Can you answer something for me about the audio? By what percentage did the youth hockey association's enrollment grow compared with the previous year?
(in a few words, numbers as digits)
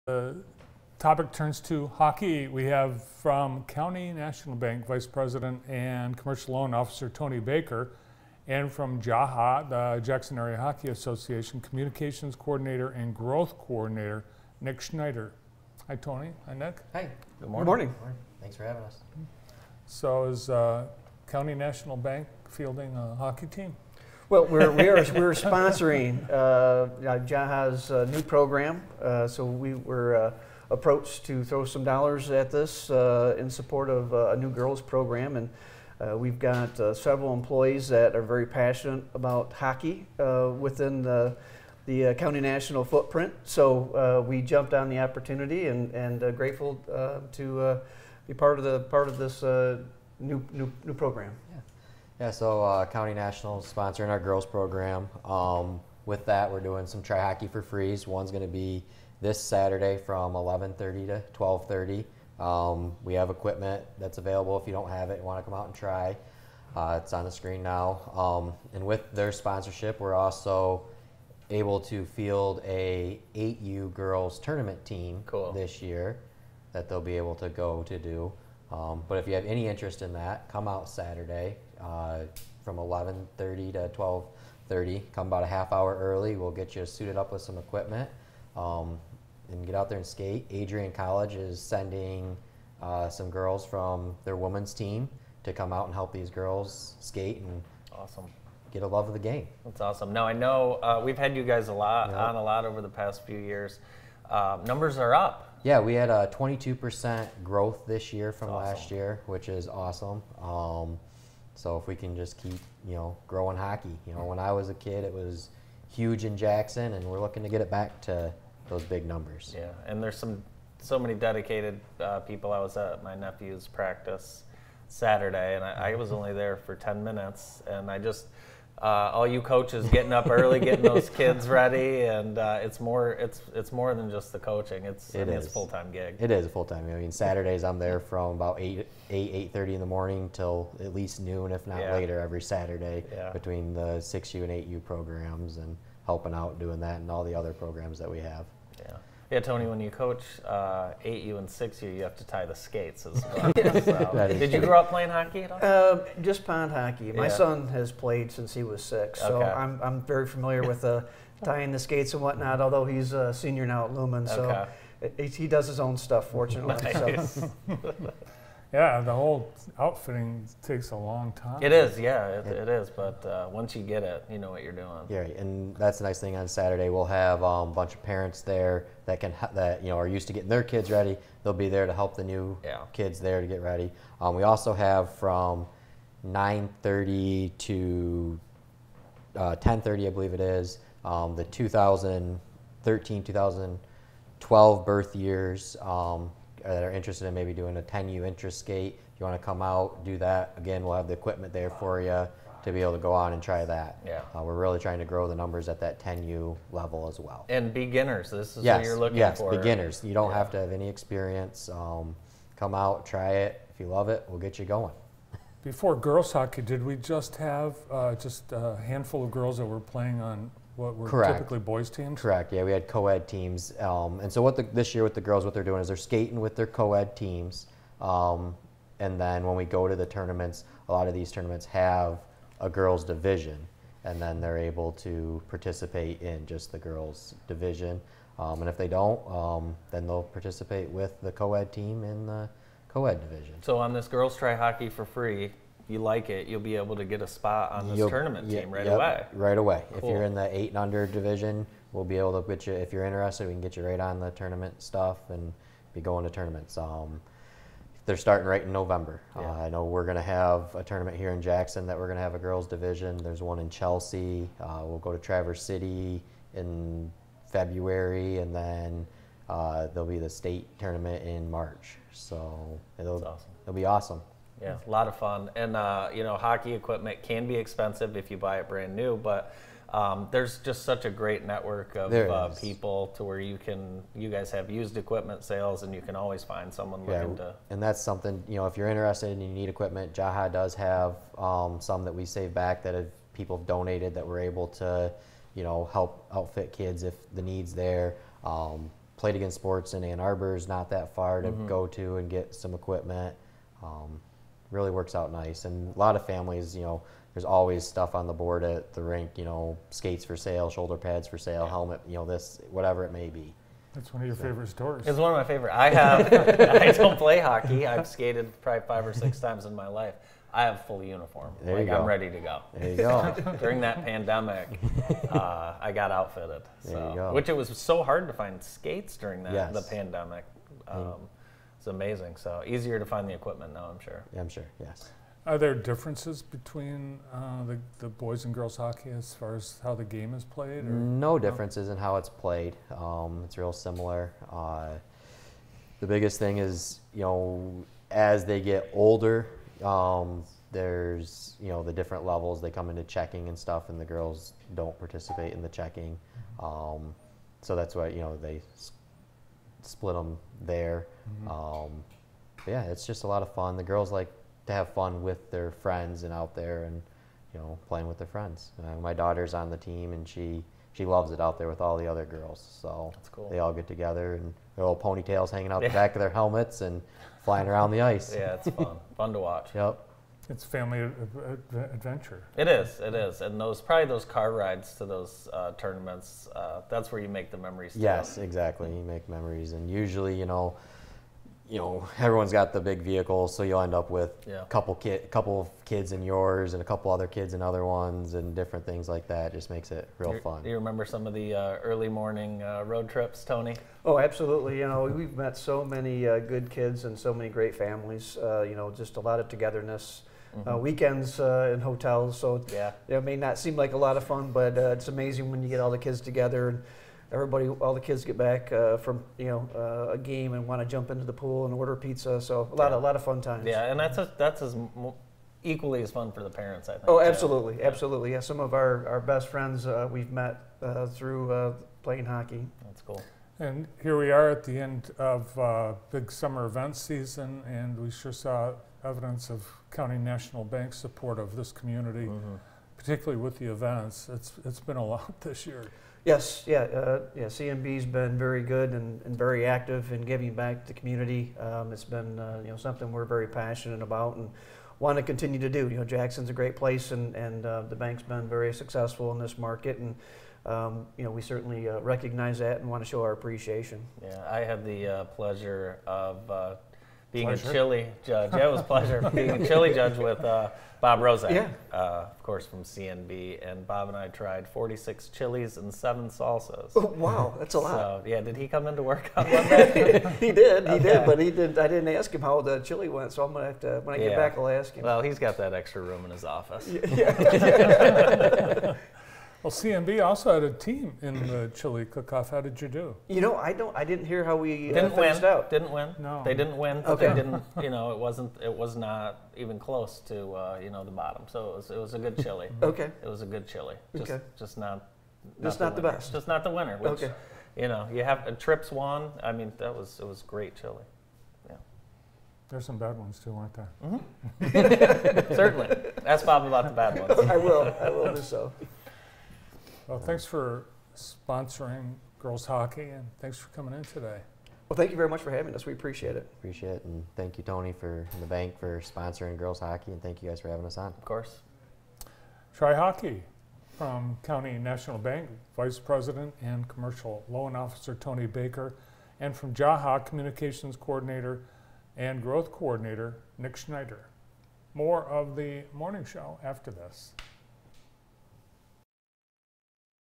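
22%.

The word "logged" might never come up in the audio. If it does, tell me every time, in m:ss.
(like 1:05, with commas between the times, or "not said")
not said.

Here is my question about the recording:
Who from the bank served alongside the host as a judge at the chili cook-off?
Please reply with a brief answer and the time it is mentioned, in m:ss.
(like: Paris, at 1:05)
Bob Rose, at 7:50.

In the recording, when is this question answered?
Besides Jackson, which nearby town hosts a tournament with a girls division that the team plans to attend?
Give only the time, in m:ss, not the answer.
4:23.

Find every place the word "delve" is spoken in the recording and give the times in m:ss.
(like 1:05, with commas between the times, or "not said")
not said.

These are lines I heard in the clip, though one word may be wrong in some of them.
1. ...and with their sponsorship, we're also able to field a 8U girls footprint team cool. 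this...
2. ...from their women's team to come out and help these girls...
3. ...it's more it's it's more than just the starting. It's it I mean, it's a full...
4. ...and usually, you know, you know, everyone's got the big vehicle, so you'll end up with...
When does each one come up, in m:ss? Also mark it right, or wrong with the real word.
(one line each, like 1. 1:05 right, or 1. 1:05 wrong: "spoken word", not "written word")
1. 1:08 wrong: "tournament", not "footprint"
2. 1:33 right
3. 2:12 wrong: "coaching", not "starting"
4. 6:29 right.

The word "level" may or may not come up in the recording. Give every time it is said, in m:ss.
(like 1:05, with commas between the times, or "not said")
3:26, 5:52.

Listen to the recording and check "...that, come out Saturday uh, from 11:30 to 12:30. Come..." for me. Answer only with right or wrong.
right.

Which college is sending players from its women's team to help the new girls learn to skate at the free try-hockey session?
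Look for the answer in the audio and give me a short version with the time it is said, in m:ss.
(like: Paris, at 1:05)
Adrian College, at 1:30.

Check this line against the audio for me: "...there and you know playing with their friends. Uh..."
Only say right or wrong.
right.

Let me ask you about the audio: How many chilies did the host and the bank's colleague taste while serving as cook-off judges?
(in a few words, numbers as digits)
46.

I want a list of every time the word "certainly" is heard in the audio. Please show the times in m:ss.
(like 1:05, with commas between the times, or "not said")
7:41, 8:35.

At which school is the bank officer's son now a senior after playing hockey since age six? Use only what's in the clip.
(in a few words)
Lumen.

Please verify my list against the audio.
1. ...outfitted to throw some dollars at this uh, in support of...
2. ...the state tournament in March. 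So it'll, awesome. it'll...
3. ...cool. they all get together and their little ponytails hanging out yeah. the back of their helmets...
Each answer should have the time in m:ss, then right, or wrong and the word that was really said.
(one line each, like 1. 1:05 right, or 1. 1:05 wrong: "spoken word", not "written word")
1. 0:30 wrong: "approached", not "outfitted"
2. 4:30 right
3. 6:13 right.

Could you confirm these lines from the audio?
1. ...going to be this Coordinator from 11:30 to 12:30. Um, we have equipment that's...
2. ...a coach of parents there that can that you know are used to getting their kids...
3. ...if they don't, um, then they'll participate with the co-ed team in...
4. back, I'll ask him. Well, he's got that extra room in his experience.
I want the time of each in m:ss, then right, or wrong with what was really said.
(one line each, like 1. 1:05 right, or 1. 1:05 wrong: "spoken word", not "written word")
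1. 0:58 wrong: "Saturday", not "Coordinator"
2. 2:57 wrong: "bunch", not "coach"
3. 3:58 right
4. 8:04 wrong: "office", not "experience".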